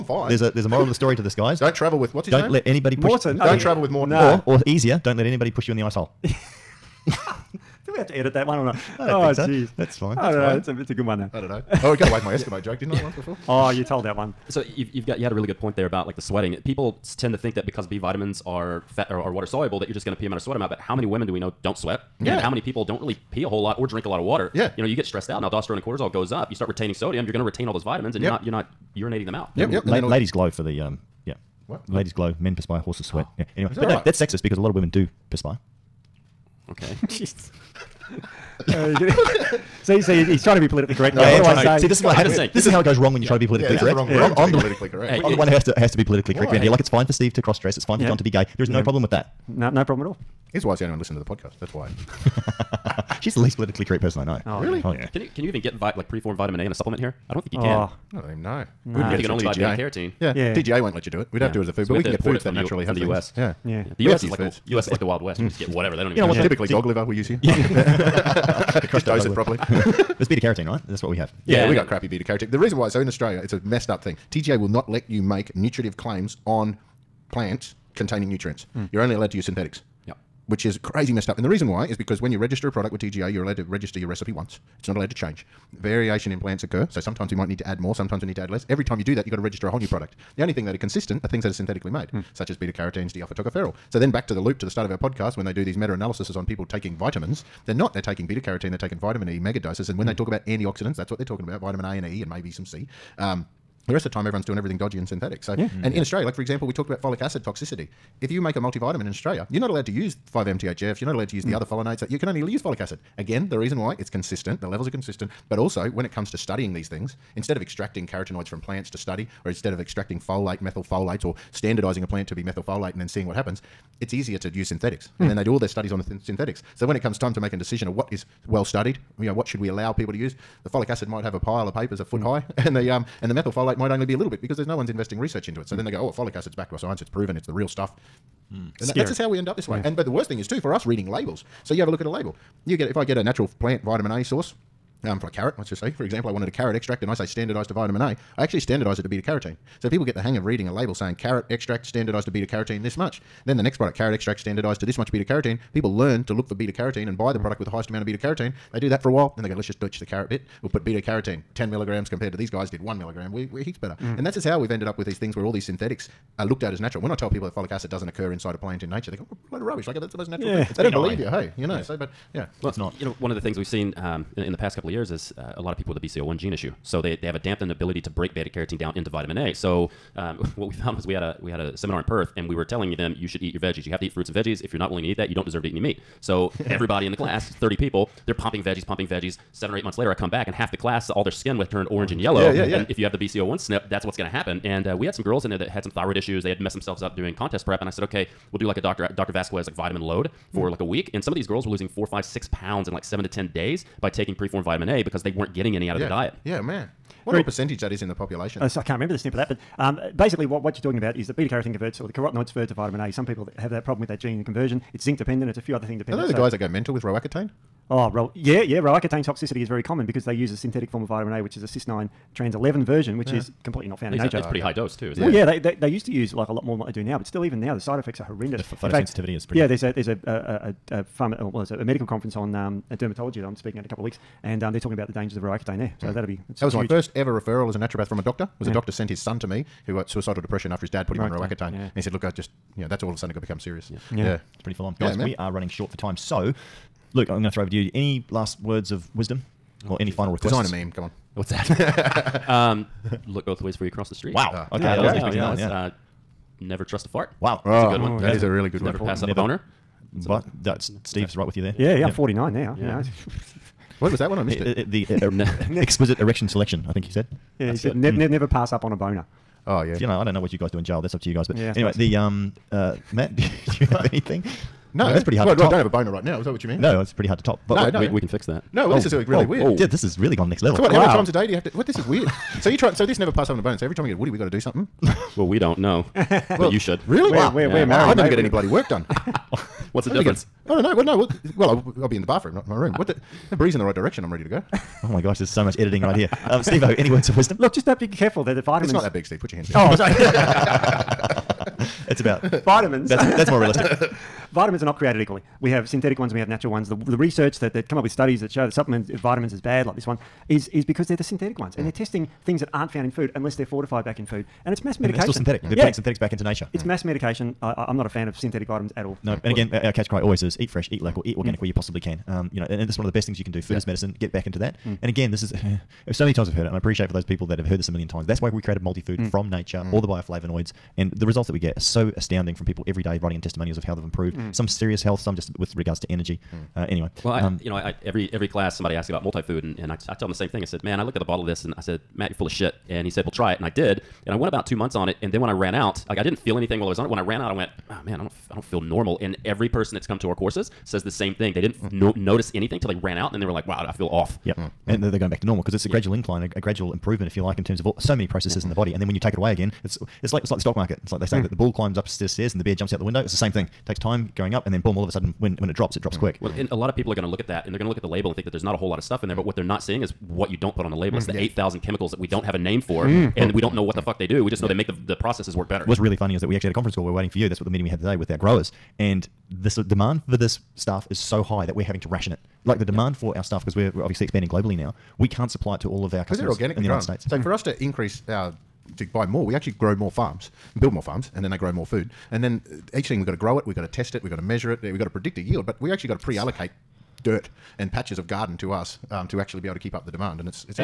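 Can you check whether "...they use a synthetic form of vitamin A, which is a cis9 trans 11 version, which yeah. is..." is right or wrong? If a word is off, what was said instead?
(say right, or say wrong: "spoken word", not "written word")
right.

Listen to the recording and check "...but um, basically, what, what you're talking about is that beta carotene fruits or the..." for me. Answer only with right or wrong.
wrong.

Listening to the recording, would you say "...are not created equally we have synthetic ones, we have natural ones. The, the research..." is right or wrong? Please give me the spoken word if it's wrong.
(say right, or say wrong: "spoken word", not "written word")
right.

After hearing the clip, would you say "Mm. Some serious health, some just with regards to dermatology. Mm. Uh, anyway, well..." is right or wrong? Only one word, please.
wrong.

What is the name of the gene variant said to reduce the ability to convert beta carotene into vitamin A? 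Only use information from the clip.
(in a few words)
BCO1.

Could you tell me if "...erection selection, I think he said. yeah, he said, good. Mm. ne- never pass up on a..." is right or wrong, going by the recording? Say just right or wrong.
right.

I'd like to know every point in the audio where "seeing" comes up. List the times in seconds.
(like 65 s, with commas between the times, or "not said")
123 s, 369 s.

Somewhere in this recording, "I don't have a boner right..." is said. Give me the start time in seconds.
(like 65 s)
275 s.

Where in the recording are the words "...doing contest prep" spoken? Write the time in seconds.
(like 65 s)
197 s.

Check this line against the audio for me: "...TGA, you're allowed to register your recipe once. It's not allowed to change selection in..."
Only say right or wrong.
wrong.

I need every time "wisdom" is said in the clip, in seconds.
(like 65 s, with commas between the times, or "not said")
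249 s, 297 s.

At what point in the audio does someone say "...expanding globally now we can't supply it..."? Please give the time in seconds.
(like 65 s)
384 s.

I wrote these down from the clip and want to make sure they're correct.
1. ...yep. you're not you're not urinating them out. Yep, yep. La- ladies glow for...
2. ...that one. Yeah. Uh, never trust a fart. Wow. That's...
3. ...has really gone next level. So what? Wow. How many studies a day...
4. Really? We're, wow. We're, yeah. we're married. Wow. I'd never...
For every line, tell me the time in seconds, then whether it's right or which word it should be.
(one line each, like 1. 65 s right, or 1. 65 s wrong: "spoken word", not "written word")
1. 28 s right
2. 255 s right
3. 280 s wrong: "times", not "studies"
4. 287 s right.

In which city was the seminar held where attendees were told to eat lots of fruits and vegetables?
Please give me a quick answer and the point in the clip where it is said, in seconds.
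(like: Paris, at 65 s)
Perth, at 182 s.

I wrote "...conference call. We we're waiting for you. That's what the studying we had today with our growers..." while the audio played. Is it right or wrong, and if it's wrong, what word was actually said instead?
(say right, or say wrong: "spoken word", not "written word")
wrong: "meeting", not "studying".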